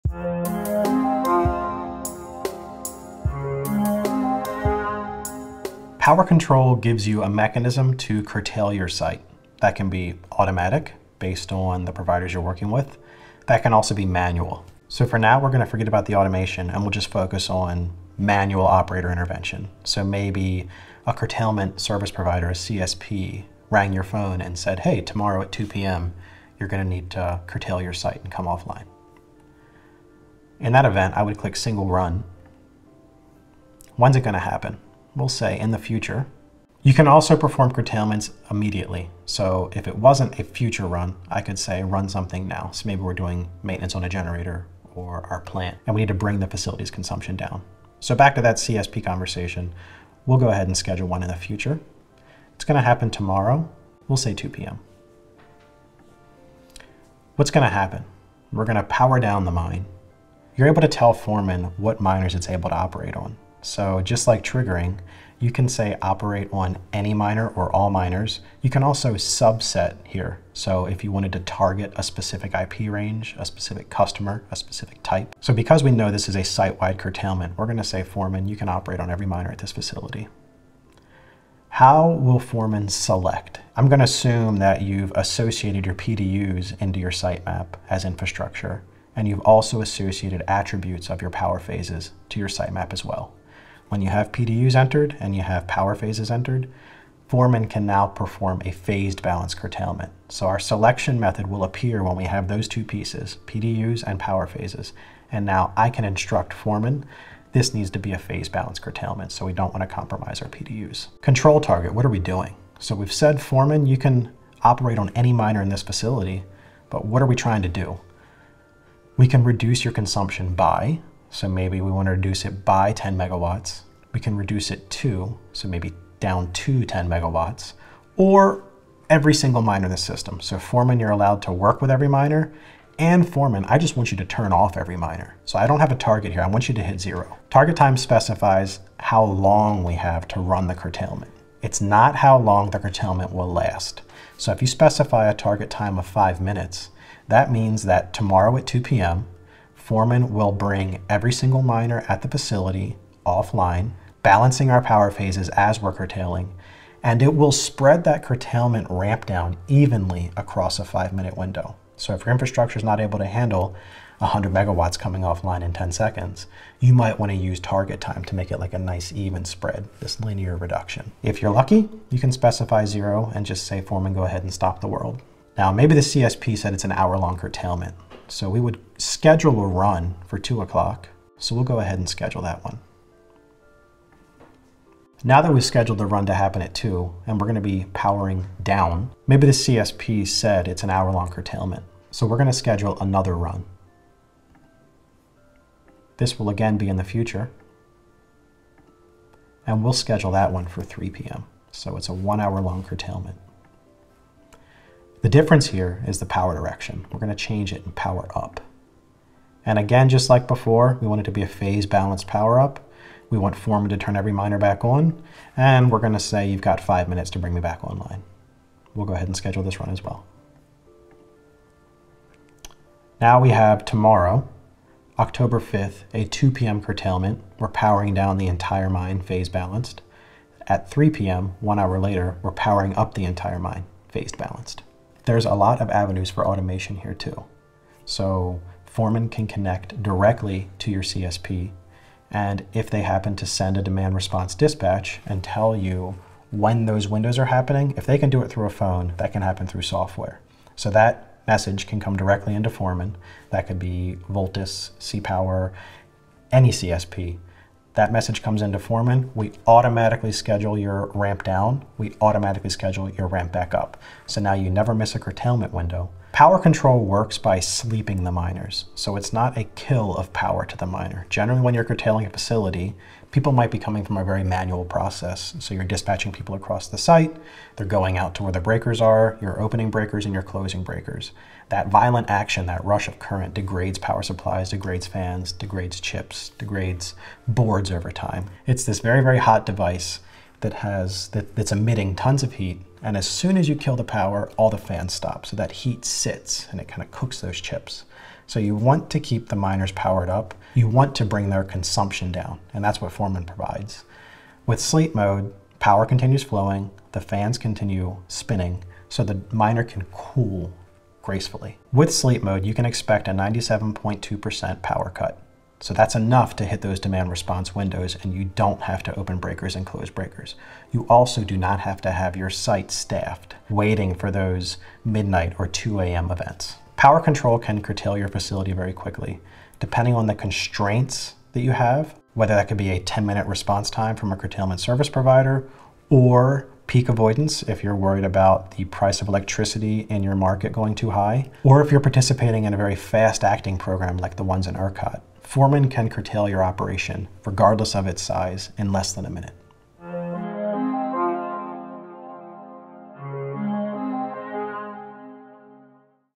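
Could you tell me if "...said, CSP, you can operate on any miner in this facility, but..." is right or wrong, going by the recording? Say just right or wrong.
wrong.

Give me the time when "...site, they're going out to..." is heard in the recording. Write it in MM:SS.
04:36.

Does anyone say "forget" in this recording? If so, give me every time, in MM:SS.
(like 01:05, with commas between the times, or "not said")
00:15.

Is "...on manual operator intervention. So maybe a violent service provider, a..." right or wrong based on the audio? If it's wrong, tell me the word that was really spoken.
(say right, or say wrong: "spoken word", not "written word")
wrong: "curtailment", not "violent".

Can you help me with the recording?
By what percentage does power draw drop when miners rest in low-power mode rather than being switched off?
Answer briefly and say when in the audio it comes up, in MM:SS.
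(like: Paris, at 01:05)
97.2%, at 05:13.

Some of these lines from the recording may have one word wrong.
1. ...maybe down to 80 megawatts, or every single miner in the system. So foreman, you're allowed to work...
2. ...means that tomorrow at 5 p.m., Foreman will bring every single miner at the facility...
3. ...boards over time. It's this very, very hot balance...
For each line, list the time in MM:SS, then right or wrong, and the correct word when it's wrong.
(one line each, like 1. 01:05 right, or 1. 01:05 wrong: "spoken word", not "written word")
1. 02:05 wrong: "10", not "80"
2. 02:27 wrong: "2", not "5"
3. 04:47 wrong: "device", not "balance".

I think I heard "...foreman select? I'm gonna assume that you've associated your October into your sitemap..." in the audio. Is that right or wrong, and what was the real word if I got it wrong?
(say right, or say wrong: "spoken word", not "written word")
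wrong: "PDUs", not "October".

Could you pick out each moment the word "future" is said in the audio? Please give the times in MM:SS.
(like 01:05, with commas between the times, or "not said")
00:35, 00:40, 00:51, 03:17.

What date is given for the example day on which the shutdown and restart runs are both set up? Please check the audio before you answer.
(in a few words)
October 5th.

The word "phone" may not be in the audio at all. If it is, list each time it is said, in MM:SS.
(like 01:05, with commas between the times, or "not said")
00:24, 04:08.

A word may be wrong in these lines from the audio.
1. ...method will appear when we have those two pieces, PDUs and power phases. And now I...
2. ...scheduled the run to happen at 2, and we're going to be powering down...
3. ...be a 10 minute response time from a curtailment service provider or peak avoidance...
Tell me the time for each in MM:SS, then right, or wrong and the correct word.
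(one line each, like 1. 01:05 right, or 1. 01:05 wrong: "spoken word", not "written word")
1. 01:41 right
2. 03:05 right
3. 05:32 right.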